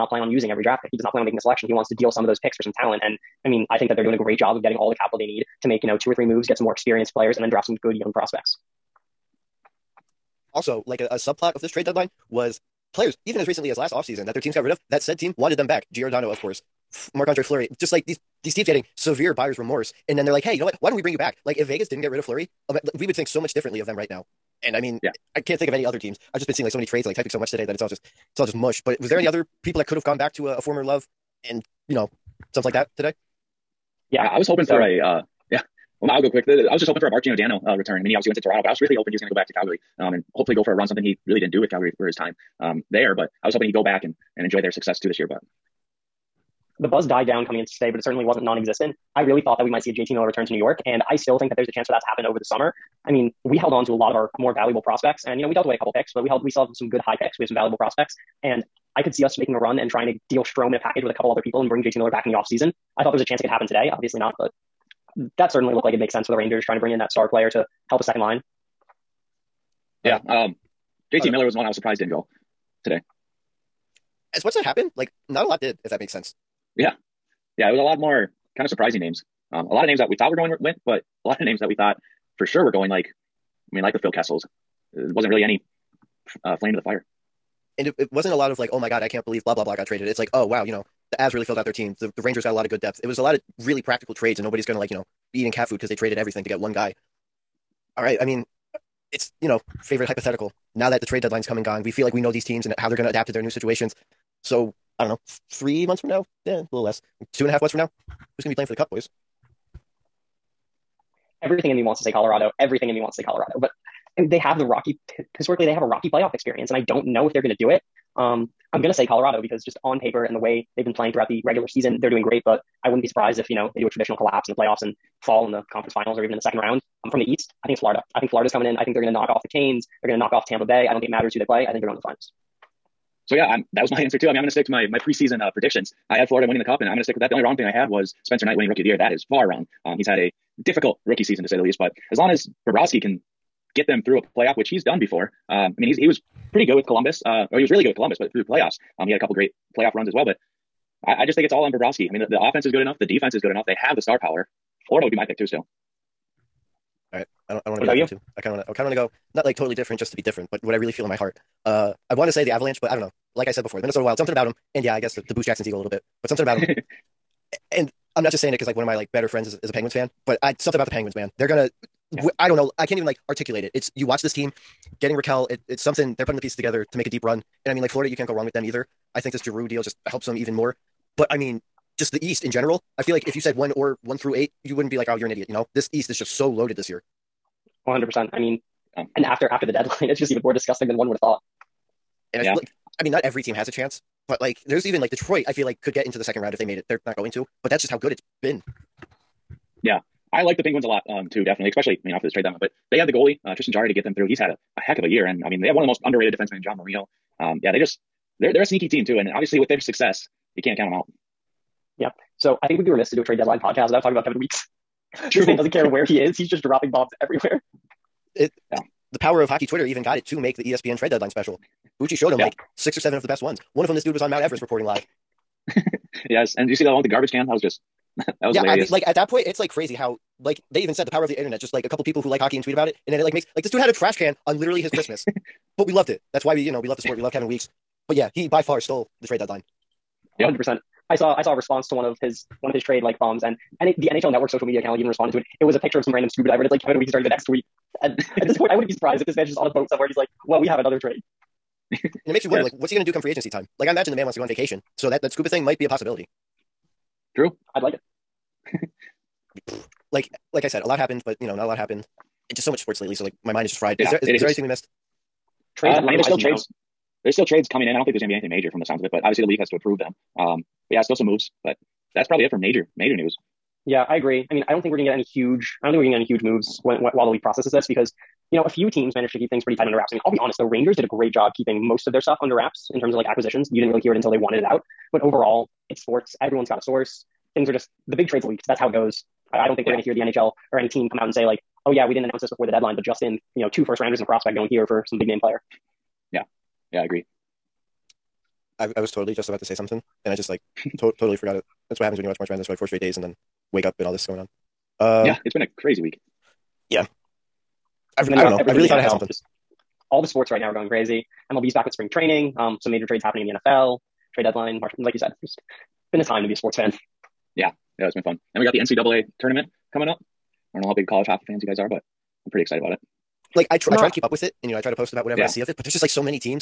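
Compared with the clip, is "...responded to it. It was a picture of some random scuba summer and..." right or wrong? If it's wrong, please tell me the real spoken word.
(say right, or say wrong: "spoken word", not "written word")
wrong: "diver", not "summer".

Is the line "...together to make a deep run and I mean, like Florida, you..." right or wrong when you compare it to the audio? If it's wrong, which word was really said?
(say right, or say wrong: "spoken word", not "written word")
right.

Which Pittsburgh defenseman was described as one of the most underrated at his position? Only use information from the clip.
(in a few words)
John Marino.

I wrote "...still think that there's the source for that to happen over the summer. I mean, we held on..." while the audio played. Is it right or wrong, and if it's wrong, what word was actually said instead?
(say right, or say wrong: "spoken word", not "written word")
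wrong: "chance", not "source".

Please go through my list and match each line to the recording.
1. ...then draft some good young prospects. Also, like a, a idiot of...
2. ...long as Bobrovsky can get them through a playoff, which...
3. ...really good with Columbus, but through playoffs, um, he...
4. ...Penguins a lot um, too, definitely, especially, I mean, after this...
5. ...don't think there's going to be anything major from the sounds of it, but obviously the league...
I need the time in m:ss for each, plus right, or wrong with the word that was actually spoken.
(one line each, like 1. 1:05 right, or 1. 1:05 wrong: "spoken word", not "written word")
1. 0:07 wrong: "subplot", not "idiot"
2. 2:22 right
3. 2:27 right
4. 3:20 right
5. 4:27 right.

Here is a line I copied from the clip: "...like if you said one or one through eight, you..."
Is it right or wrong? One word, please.
right.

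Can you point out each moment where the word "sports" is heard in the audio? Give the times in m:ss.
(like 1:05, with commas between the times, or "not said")
3:57, 4:22, 4:46, 5:10, 5:16.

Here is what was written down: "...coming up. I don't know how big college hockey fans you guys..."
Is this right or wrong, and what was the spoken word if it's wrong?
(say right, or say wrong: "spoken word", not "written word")
right.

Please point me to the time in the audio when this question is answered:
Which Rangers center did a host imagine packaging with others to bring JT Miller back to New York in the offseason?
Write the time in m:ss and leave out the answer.
1:00.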